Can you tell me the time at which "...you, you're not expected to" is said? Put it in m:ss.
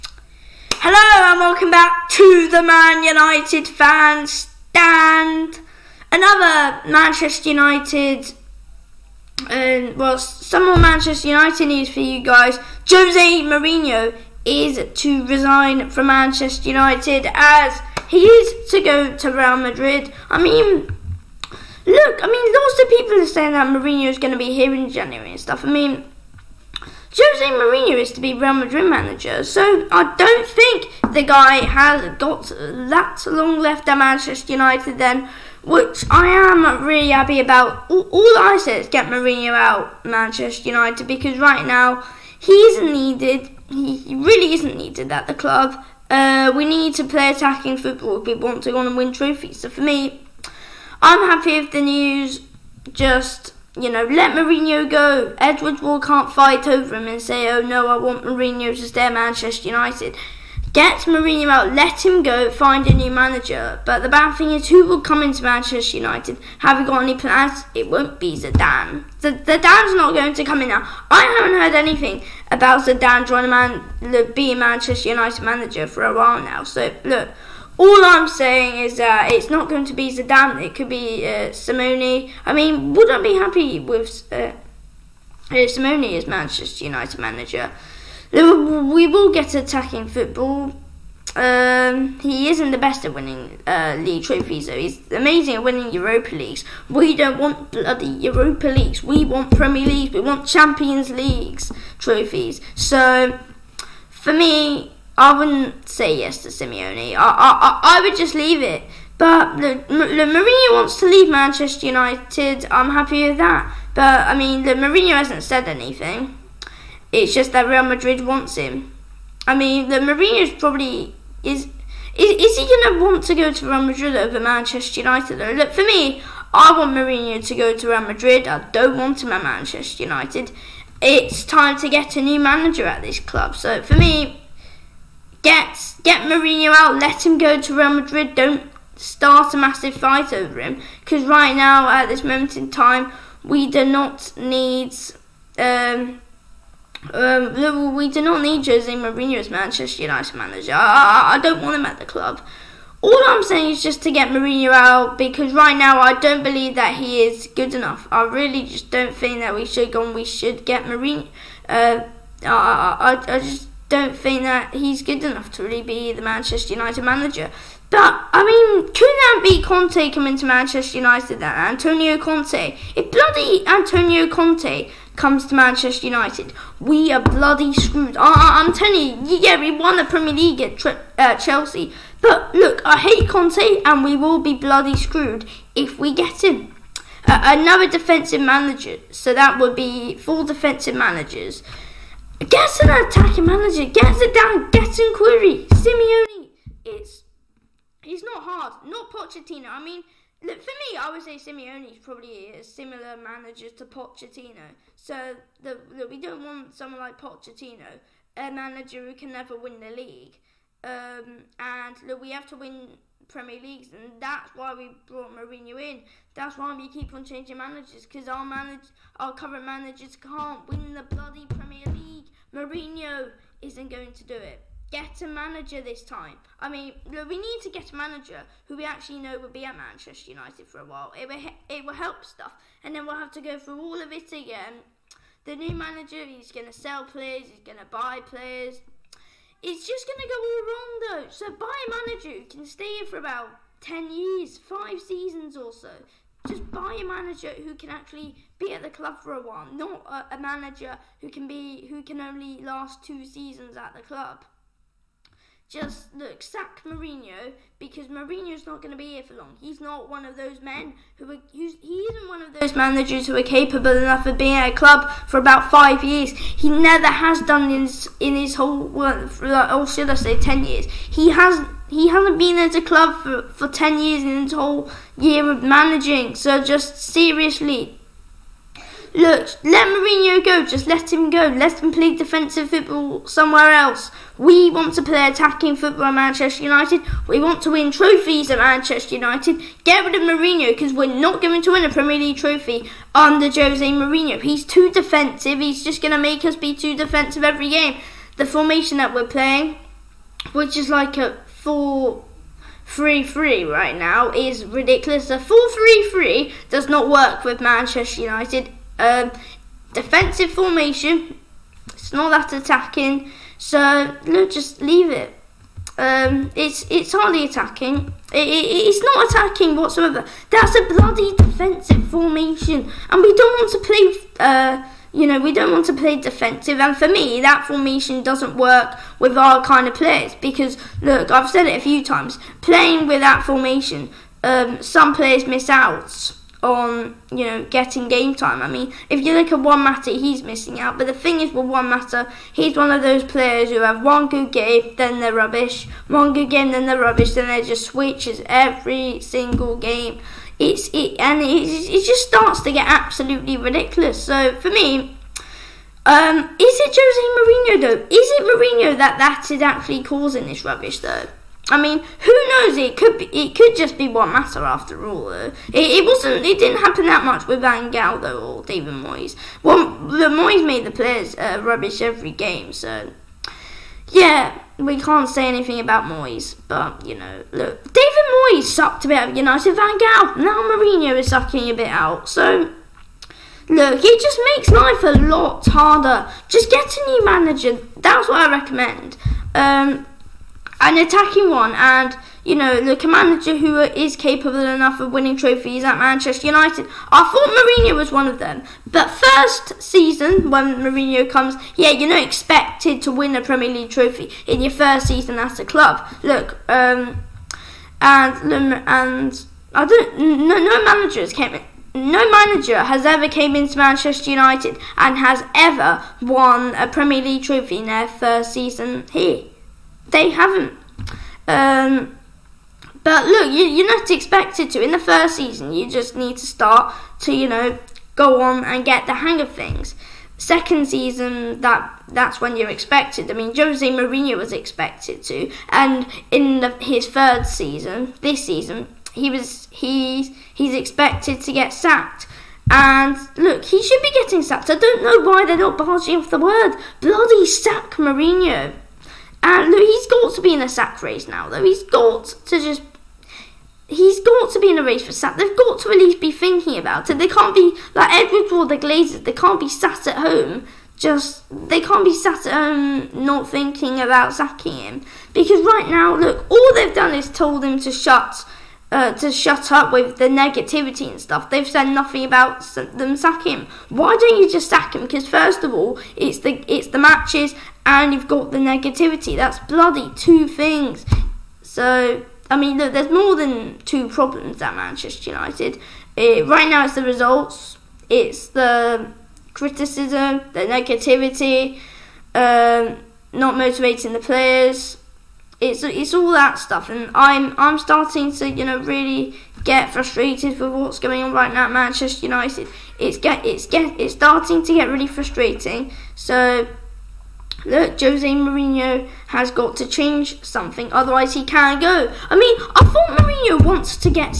7:03.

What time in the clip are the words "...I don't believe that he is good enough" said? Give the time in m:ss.
2:35.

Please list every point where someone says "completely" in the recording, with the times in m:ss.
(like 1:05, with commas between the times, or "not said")
not said.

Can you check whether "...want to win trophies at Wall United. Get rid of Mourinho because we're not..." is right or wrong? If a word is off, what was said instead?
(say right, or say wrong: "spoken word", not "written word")
wrong: "Manchester", not "Wall".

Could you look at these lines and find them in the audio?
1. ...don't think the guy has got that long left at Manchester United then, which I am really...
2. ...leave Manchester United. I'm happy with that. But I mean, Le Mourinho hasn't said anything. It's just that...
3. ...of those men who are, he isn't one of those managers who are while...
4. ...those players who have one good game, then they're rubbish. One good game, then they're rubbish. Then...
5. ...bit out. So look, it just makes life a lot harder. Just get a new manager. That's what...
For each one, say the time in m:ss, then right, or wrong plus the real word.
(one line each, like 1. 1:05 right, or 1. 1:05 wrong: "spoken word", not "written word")
1. 0:30 right
2. 1:51 right
3. 4:20 wrong: "capable", not "while"
4. 5:43 right
5. 6:21 right.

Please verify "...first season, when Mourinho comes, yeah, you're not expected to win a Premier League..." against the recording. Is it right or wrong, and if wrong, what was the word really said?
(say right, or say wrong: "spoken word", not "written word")
right.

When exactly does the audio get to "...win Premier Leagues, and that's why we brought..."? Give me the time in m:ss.
3:32.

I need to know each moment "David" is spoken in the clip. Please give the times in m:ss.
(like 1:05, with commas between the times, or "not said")
6:08, 6:17.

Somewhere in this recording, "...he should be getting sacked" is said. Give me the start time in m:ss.
7:23.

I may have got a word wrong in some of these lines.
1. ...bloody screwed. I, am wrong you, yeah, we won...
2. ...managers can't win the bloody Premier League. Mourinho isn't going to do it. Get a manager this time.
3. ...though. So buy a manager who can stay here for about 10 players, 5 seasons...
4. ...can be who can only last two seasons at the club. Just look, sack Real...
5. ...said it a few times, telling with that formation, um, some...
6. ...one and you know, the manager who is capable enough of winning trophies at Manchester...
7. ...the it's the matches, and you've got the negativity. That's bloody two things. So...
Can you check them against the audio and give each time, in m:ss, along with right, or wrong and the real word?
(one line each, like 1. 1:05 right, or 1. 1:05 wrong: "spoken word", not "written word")
1. 2:57 wrong: "telling", not "wrong"
2. 3:39 right
3. 4:01 wrong: "years", not "players"
4. 4:11 wrong: "Mourinho", not "Real"
5. 5:31 wrong: "playing", not "telling"
6. 6:31 right
7. 7:56 right.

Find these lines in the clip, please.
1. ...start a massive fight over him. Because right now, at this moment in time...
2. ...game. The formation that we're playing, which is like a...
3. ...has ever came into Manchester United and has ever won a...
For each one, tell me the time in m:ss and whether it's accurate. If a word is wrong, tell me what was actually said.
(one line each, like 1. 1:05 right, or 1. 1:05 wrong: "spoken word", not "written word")
1. 2:18 right
2. 4:57 right
3. 6:52 right.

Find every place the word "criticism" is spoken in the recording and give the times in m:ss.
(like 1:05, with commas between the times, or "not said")
8:09.